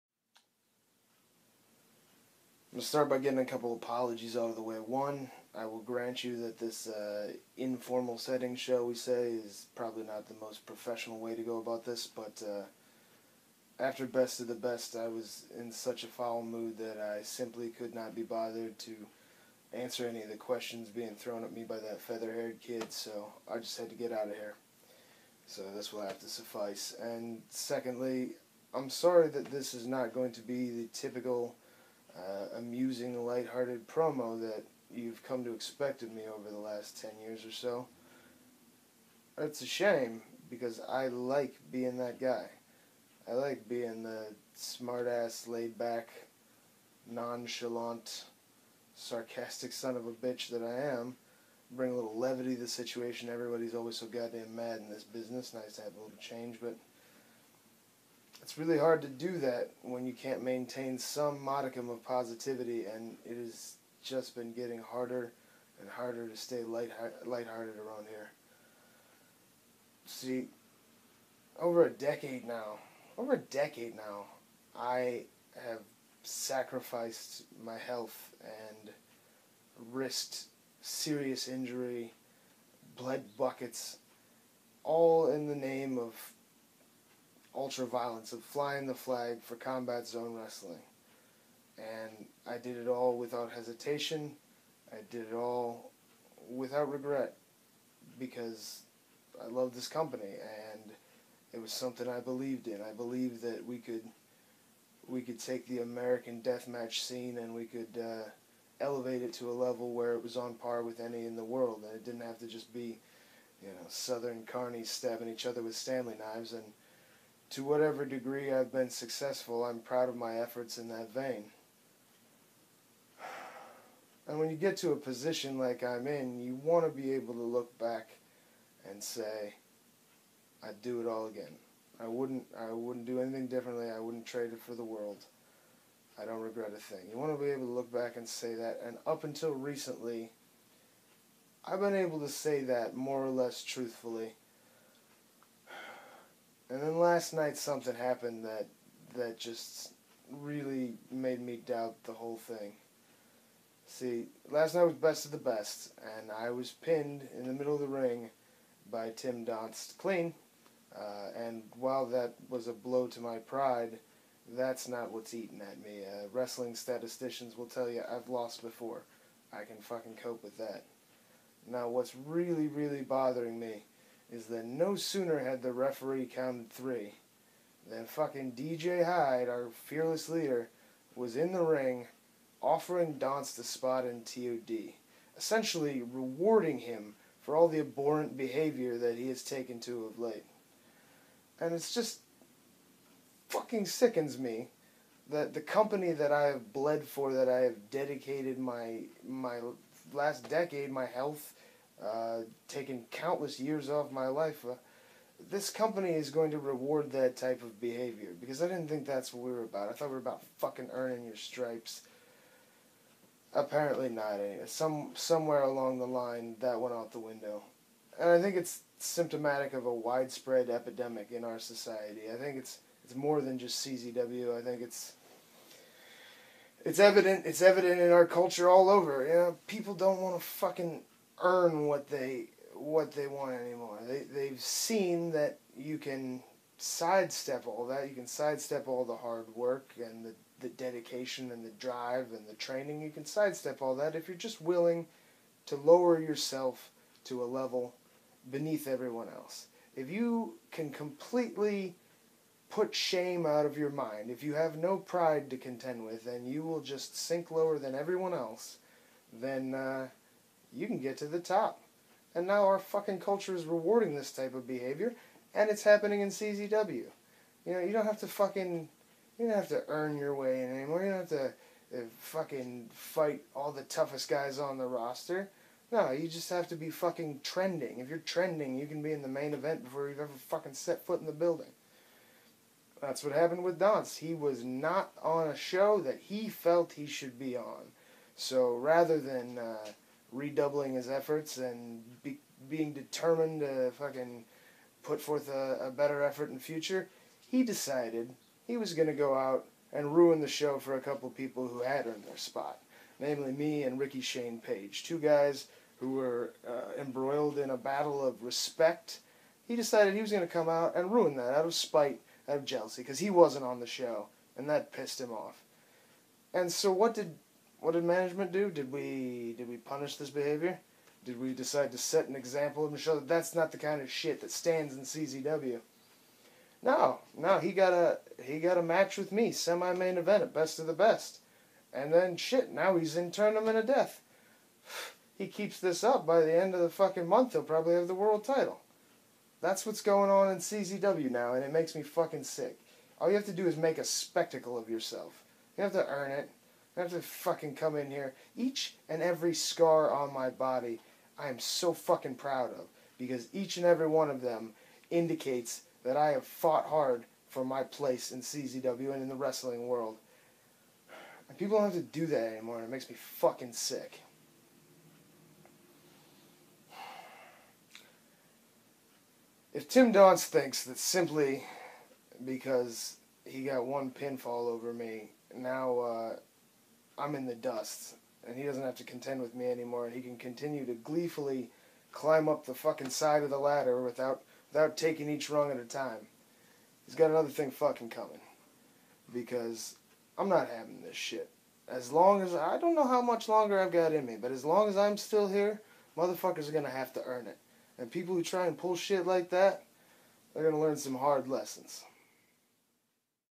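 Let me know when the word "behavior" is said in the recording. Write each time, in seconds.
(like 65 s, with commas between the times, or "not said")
188 s, 207 s, 264 s, 320 s.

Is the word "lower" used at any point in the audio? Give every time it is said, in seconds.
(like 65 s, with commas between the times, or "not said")
245 s, 257 s.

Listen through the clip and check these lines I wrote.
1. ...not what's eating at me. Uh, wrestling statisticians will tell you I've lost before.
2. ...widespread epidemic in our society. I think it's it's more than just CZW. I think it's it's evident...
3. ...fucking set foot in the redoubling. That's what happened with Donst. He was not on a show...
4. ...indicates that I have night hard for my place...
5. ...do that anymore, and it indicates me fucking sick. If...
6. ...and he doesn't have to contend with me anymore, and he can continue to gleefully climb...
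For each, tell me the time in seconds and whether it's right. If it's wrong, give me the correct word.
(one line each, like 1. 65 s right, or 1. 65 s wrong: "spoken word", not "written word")
1. 164 s right
2. 219 s right
3. 280 s wrong: "building", not "redoubling"
4. 355 s wrong: "fought", not "night"
5. 362 s wrong: "makes", not "indicates"
6. 378 s right.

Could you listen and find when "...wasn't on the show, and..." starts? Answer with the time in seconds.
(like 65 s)
313 s.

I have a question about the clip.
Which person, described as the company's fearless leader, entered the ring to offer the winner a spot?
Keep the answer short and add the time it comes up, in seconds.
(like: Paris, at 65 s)
DJ Hyde, at 178 s.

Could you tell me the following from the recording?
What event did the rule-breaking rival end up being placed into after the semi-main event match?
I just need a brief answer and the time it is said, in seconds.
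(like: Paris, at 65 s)
Tournament of Death, at 333 s.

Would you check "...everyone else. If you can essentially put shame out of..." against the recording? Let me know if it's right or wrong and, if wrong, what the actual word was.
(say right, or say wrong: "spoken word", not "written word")
wrong: "completely", not "essentially".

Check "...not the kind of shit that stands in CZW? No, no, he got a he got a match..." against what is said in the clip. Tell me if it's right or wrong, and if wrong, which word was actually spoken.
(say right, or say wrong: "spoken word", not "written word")
right.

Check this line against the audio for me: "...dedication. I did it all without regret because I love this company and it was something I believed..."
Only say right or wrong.
wrong.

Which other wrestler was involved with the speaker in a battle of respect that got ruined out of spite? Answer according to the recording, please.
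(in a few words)
Ricky Shane Page.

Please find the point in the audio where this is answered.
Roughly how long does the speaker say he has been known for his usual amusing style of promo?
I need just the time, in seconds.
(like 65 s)
37 s.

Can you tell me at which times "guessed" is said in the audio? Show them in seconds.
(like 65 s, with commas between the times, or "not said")
not said.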